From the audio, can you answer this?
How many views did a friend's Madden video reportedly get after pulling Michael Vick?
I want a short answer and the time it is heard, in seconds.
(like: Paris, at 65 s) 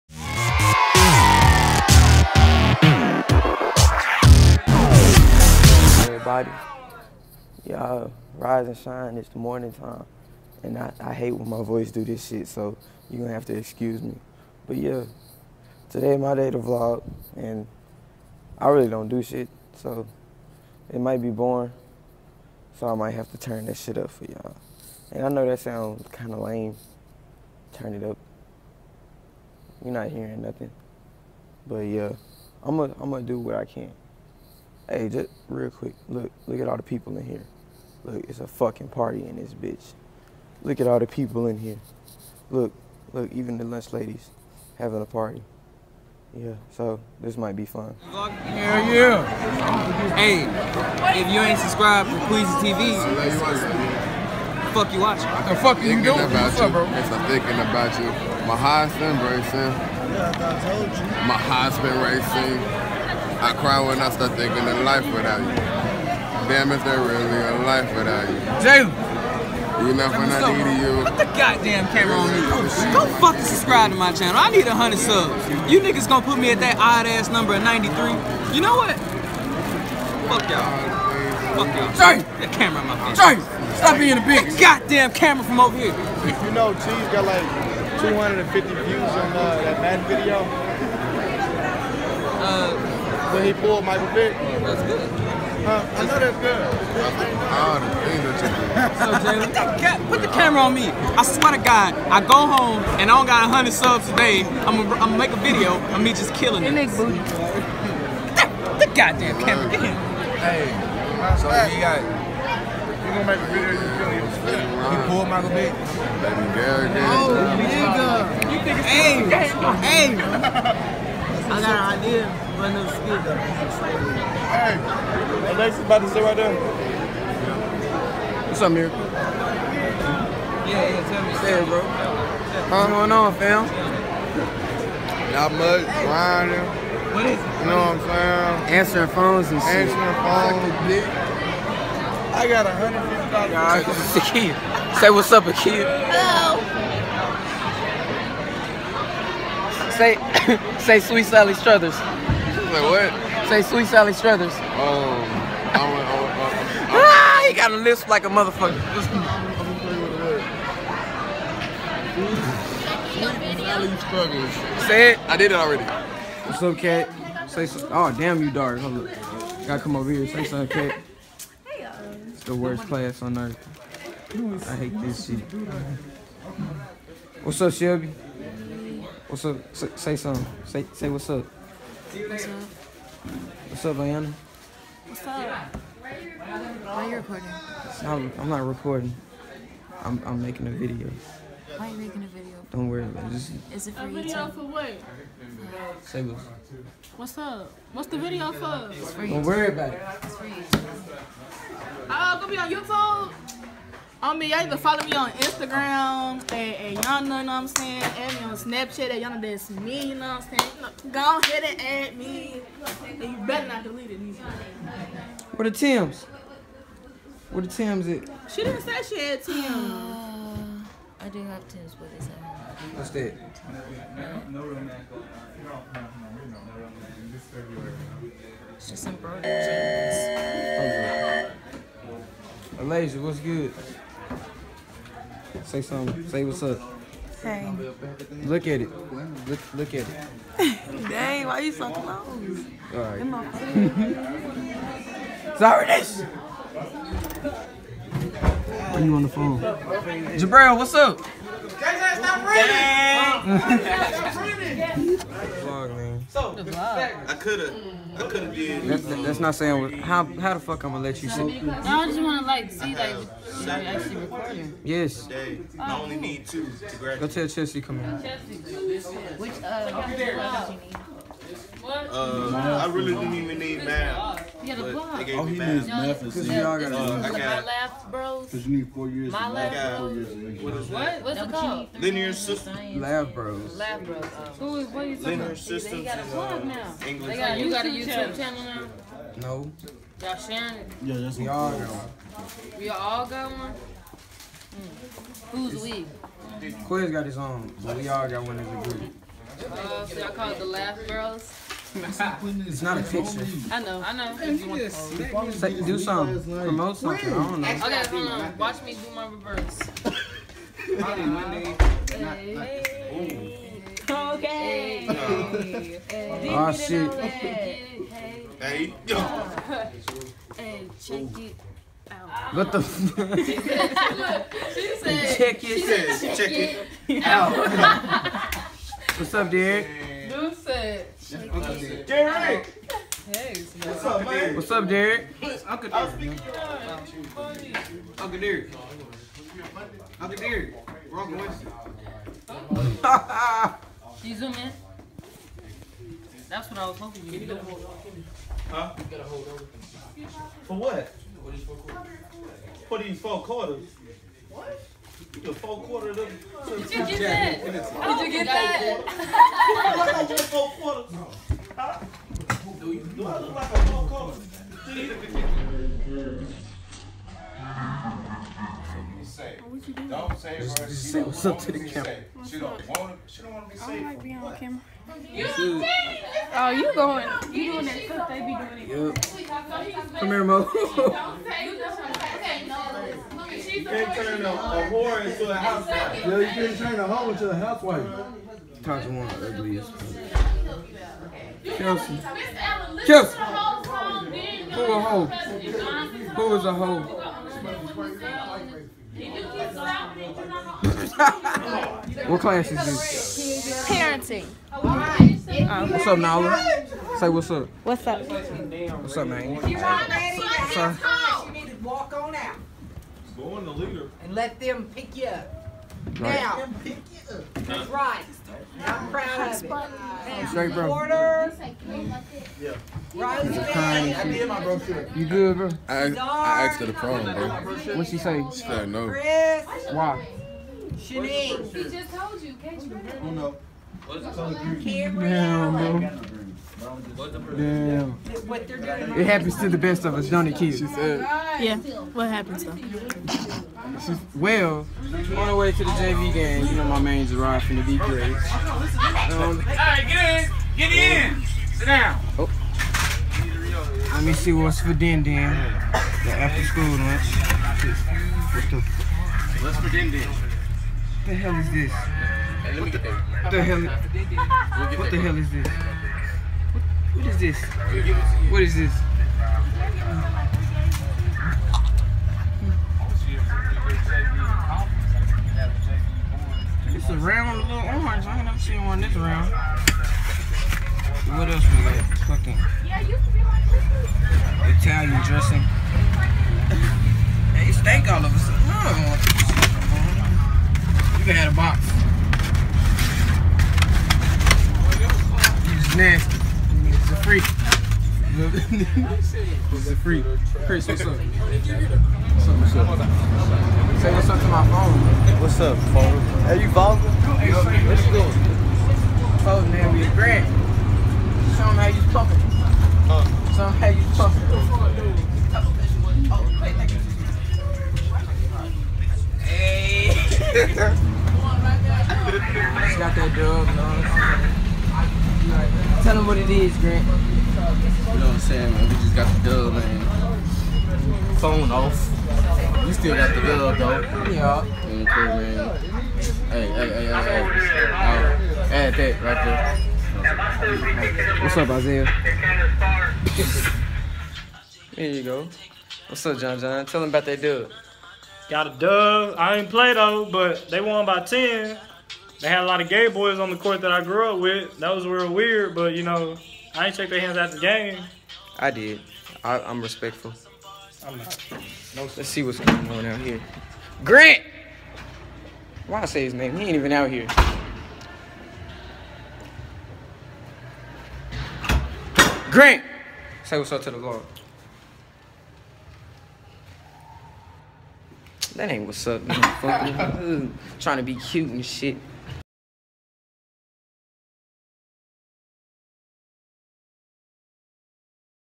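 250, at 88 s.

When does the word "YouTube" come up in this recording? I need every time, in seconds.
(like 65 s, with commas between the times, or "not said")
202 s, 287 s.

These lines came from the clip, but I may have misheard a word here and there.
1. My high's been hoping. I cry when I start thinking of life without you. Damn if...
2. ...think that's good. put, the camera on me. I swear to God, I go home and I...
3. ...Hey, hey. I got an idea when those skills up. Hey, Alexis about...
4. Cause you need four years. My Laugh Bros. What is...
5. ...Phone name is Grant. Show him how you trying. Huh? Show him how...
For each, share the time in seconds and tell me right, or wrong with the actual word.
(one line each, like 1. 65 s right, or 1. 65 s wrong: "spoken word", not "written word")
1. 61 s wrong: "racing", not "hoping"
2. 99 s right
3. 118 s right
4. 278 s right
5. 509 s wrong: "talking", not "trying".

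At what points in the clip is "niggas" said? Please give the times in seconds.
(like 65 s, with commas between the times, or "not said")
75 s, 117 s.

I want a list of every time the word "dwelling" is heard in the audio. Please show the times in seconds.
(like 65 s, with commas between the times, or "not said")
not said.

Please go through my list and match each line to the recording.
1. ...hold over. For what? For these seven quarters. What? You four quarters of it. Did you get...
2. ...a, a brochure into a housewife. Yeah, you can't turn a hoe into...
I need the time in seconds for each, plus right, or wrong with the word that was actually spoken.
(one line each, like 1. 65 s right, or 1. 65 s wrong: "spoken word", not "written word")
1. 349 s wrong: "four", not "seven"
2. 384 s wrong: "whore", not "brochure".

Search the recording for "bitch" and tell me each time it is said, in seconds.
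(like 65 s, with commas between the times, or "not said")
39 s, 84 s.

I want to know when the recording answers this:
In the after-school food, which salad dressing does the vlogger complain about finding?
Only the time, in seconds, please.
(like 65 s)
484 s.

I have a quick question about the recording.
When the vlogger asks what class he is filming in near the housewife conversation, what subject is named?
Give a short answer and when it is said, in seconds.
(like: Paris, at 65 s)
Parenting, at 403 s.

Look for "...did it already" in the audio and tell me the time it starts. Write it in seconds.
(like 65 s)
165 s.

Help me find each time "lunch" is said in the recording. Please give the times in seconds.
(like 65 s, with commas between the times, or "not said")
43 s, 456 s.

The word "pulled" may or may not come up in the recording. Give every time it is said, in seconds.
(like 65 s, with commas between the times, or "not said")
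93 s, 115 s.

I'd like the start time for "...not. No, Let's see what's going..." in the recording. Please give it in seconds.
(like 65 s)
561 s.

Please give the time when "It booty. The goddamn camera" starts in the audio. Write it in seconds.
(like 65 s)
106 s.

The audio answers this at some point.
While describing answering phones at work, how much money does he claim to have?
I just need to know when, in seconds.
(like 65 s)
142 s.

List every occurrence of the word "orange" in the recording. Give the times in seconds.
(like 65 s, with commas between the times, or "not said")
477 s.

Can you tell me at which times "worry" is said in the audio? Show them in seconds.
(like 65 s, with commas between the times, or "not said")
192 s, 199 s.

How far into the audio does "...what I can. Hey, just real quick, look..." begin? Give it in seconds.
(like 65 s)
33 s.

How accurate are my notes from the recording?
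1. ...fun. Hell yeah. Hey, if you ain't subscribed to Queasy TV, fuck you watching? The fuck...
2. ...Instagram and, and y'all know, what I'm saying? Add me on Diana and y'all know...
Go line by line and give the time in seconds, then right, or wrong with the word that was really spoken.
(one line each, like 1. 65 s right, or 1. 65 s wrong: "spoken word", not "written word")
1. 47 s right
2. 205 s wrong: "Snapchat", not "Diana".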